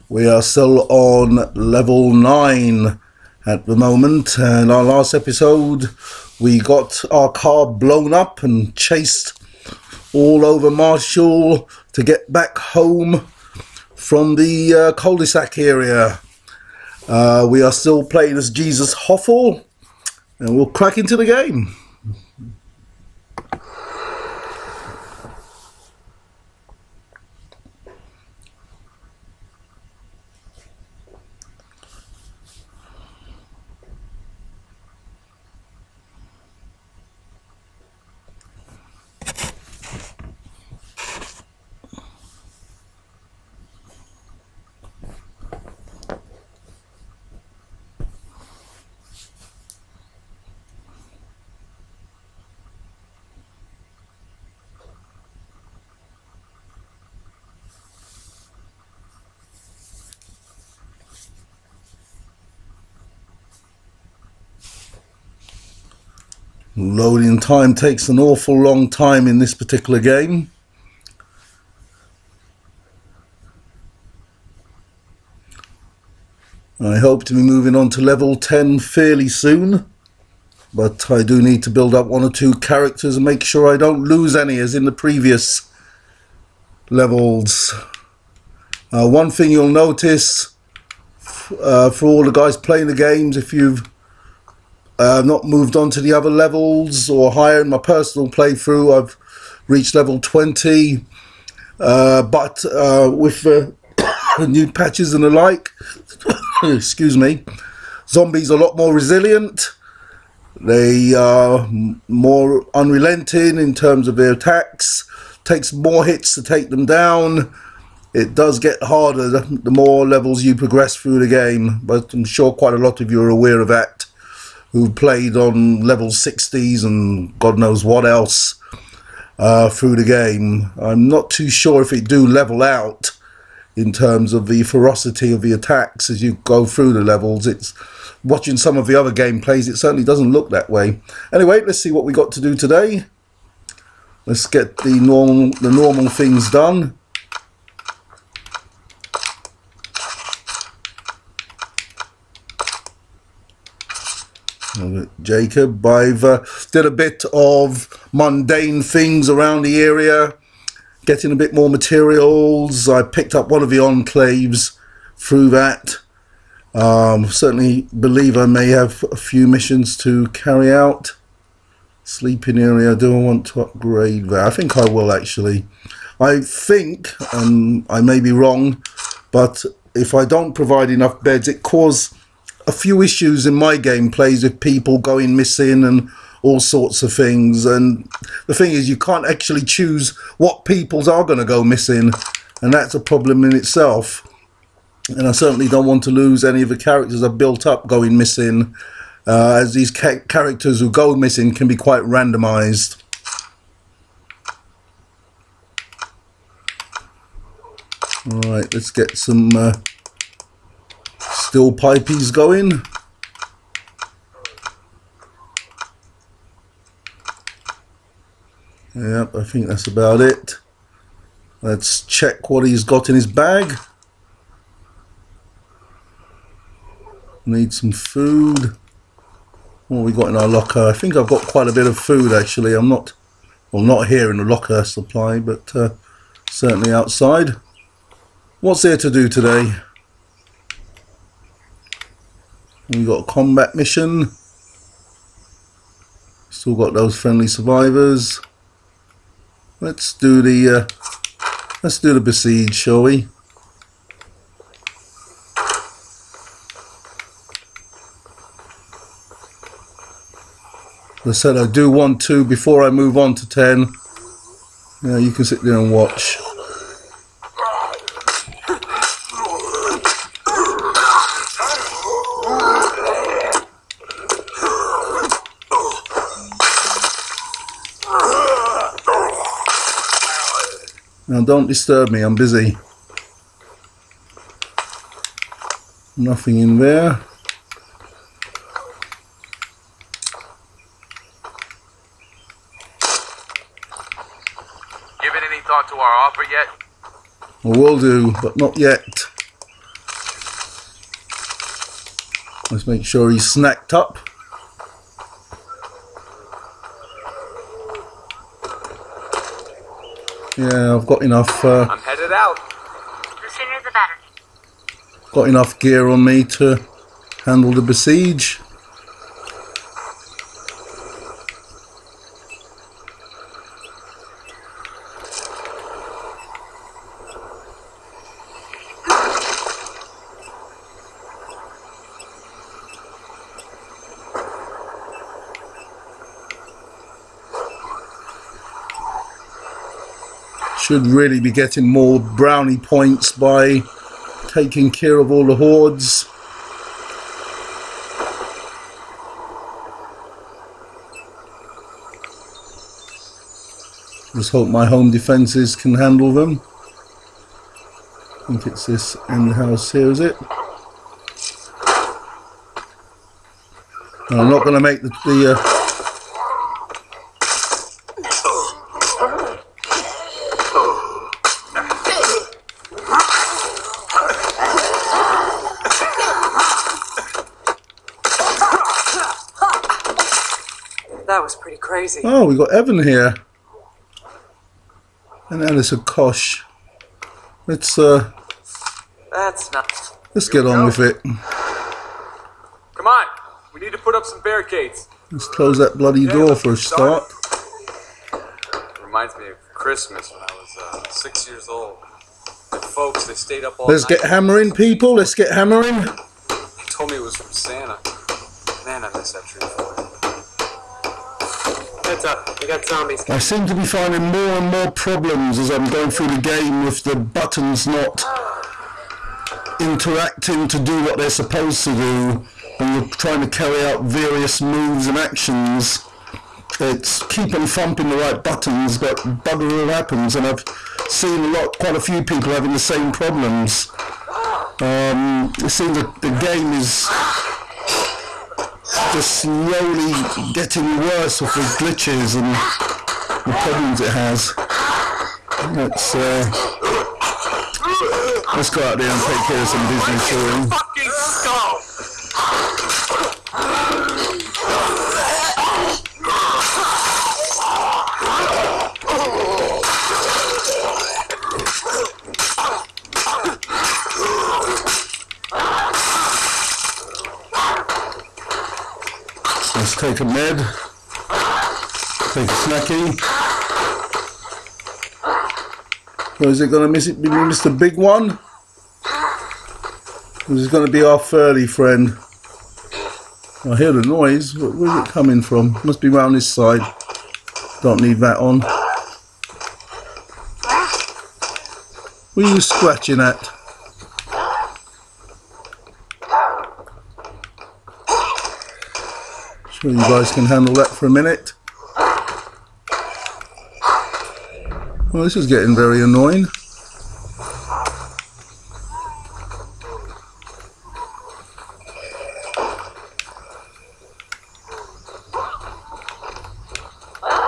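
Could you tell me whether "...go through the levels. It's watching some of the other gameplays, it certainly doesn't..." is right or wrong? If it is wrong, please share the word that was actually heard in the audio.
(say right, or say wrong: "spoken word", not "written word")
right.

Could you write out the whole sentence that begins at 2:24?
Let's get the normal the normal things done.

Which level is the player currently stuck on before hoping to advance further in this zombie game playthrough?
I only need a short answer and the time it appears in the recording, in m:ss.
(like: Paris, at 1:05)
9, at 0:01.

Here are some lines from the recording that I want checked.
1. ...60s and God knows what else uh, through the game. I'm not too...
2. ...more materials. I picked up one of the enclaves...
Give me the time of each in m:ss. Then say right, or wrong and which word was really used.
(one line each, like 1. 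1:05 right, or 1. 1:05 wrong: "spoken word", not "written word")
1. 2:06 right
2. 2:41 right.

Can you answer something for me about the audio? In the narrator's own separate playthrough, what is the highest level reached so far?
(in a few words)
20.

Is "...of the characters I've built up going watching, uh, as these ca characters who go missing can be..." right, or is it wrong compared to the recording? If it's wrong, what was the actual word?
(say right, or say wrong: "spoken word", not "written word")
wrong: "missing", not "watching".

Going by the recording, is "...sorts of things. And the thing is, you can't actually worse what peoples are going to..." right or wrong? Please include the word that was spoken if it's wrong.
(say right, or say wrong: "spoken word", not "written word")
wrong: "choose", not "worse".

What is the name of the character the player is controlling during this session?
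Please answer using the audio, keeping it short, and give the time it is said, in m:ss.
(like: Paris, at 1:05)
Jesus Hoffel, at 0:18.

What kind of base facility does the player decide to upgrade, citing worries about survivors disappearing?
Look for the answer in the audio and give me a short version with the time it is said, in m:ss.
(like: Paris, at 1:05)
Sleeping area, at 2:52.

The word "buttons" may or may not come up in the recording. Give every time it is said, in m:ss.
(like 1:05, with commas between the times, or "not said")
6:57, 7:08.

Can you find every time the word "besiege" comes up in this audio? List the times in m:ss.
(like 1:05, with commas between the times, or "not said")
4:12, 5:17.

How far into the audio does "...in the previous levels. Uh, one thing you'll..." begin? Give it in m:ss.
1:24.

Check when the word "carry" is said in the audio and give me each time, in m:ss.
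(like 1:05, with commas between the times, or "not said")
2:50, 7:03.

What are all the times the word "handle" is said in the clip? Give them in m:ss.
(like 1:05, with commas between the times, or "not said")
5:17, 5:55, 8:20.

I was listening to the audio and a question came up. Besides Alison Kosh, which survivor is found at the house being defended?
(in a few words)
Evan.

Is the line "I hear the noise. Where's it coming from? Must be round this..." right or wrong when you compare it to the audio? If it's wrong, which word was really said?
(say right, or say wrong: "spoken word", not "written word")
right.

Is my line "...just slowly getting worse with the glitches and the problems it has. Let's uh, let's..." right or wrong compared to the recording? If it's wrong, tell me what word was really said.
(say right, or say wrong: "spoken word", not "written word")
right.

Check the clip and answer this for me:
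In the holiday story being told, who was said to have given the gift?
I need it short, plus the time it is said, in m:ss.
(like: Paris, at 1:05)
Santa, at 6:47.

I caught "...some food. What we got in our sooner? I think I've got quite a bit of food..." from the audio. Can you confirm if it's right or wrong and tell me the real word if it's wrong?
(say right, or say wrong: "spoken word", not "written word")
wrong: "locker", not "sooner".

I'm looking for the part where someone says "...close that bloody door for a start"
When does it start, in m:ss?
6:35.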